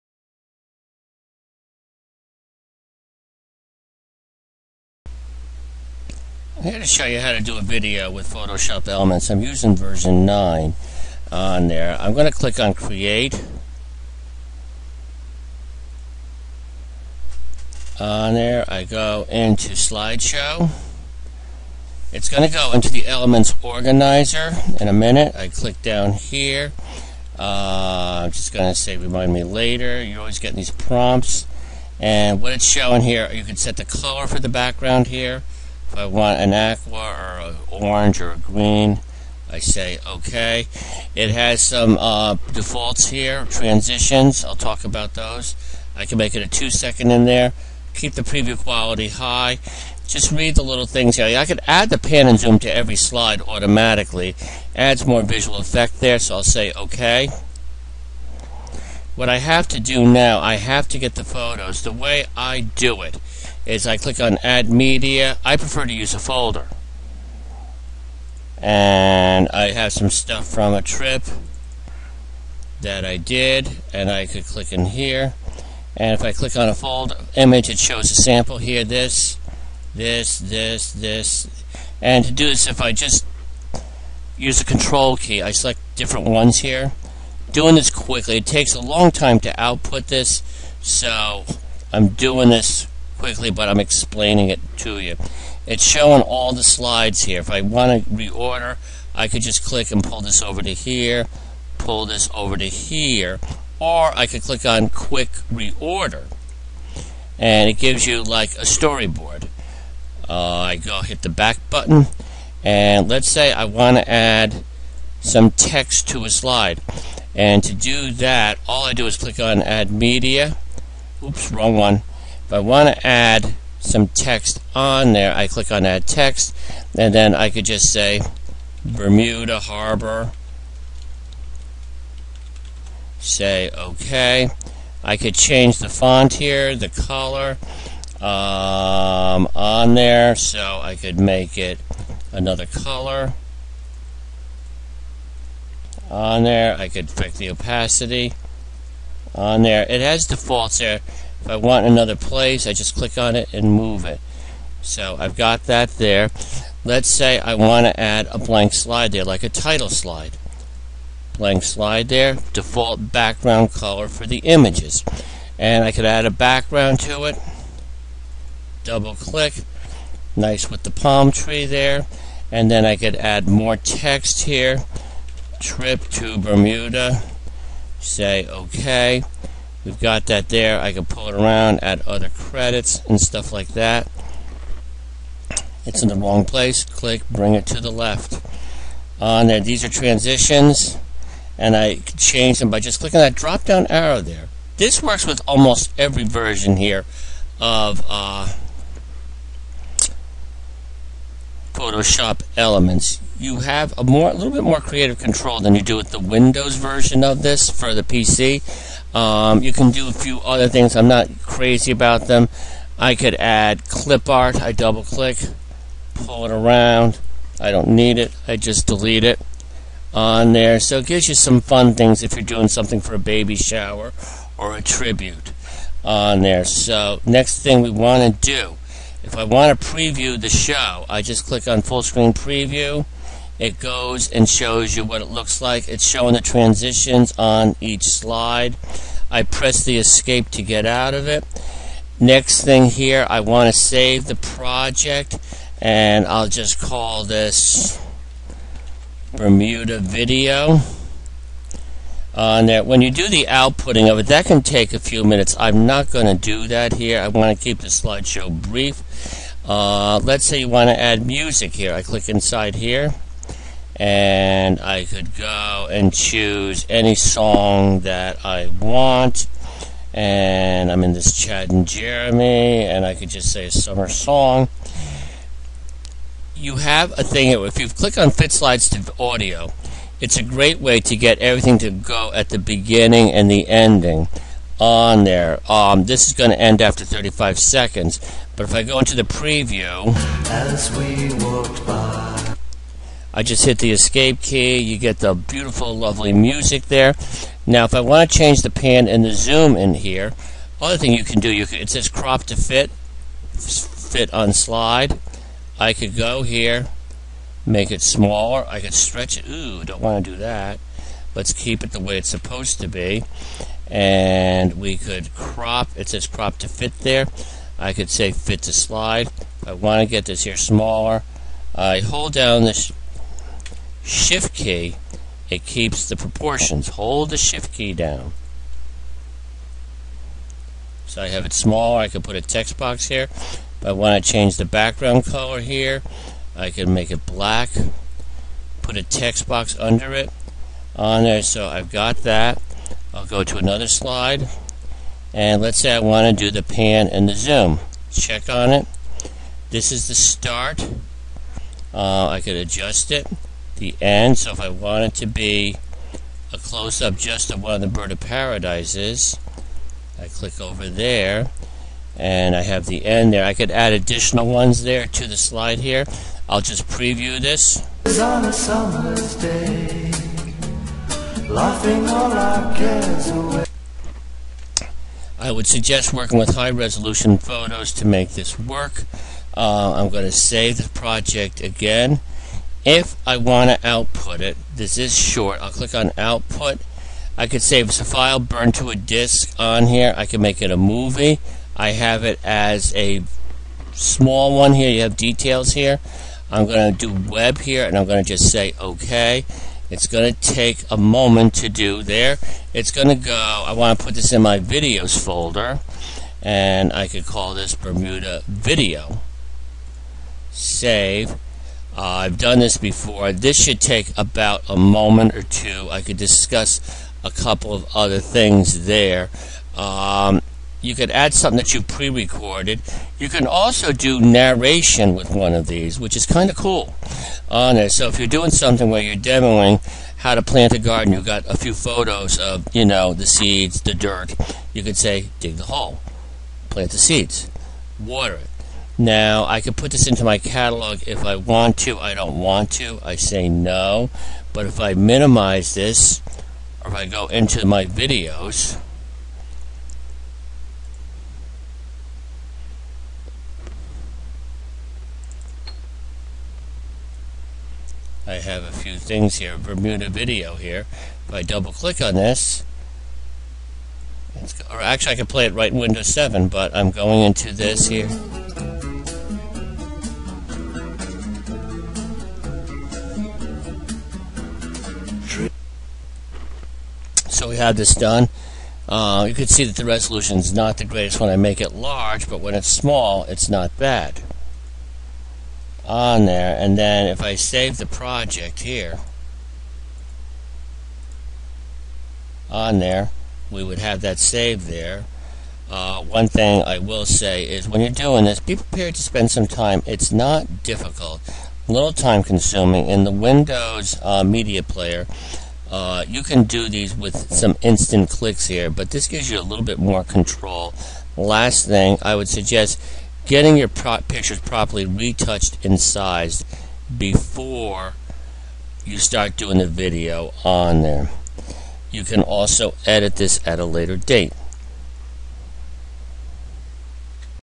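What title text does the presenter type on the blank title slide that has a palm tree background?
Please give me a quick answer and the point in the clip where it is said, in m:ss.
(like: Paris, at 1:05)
Trip to Bermuda, at 2:55.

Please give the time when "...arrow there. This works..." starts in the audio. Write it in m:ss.
3:13.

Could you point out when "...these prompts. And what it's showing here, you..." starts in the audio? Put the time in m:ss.
0:30.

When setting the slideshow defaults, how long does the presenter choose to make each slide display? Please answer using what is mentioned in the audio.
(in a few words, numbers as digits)
2 seconds.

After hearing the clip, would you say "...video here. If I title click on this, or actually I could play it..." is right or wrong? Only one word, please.
wrong.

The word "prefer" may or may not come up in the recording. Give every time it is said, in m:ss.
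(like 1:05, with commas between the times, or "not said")
1:05.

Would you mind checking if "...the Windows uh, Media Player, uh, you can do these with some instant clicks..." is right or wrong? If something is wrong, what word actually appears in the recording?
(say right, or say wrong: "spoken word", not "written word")
right.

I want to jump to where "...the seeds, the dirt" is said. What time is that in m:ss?
7:13.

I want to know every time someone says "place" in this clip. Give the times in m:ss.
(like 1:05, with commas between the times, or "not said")
2:32, 3:06.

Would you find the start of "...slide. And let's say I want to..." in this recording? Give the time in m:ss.
5:43.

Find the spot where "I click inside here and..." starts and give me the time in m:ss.
4:21.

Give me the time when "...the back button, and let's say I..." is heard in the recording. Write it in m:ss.
1:51.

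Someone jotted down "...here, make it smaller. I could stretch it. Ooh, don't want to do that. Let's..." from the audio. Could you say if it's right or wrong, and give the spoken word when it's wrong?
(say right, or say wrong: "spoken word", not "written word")
right.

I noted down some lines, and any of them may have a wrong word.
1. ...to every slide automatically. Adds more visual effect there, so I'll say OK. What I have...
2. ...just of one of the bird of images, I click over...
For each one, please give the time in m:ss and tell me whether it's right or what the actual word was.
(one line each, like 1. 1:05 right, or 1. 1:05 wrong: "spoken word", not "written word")
1. 0:52 right
2. 5:57 wrong: "paradises", not "images".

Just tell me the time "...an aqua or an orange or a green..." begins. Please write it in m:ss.
0:36.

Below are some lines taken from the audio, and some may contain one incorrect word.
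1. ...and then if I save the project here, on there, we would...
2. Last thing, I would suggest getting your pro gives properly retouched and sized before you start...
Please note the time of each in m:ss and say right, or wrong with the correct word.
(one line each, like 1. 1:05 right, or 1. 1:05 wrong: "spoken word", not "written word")
1. 8:06 right
2. 8:31 wrong: "pictures", not "gives".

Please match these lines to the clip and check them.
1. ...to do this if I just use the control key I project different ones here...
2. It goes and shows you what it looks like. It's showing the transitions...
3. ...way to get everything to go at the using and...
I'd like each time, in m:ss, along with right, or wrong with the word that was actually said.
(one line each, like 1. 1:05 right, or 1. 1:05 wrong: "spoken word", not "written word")
1. 1:22 wrong: "select", not "project"
2. 3:53 right
3. 4:40 wrong: "beginning", not "using".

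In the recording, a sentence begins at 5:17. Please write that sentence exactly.
I could say fit to slide.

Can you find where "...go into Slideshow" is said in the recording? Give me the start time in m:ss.
0:18.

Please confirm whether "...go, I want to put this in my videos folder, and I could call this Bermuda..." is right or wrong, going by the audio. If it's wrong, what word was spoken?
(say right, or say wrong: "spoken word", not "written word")
right.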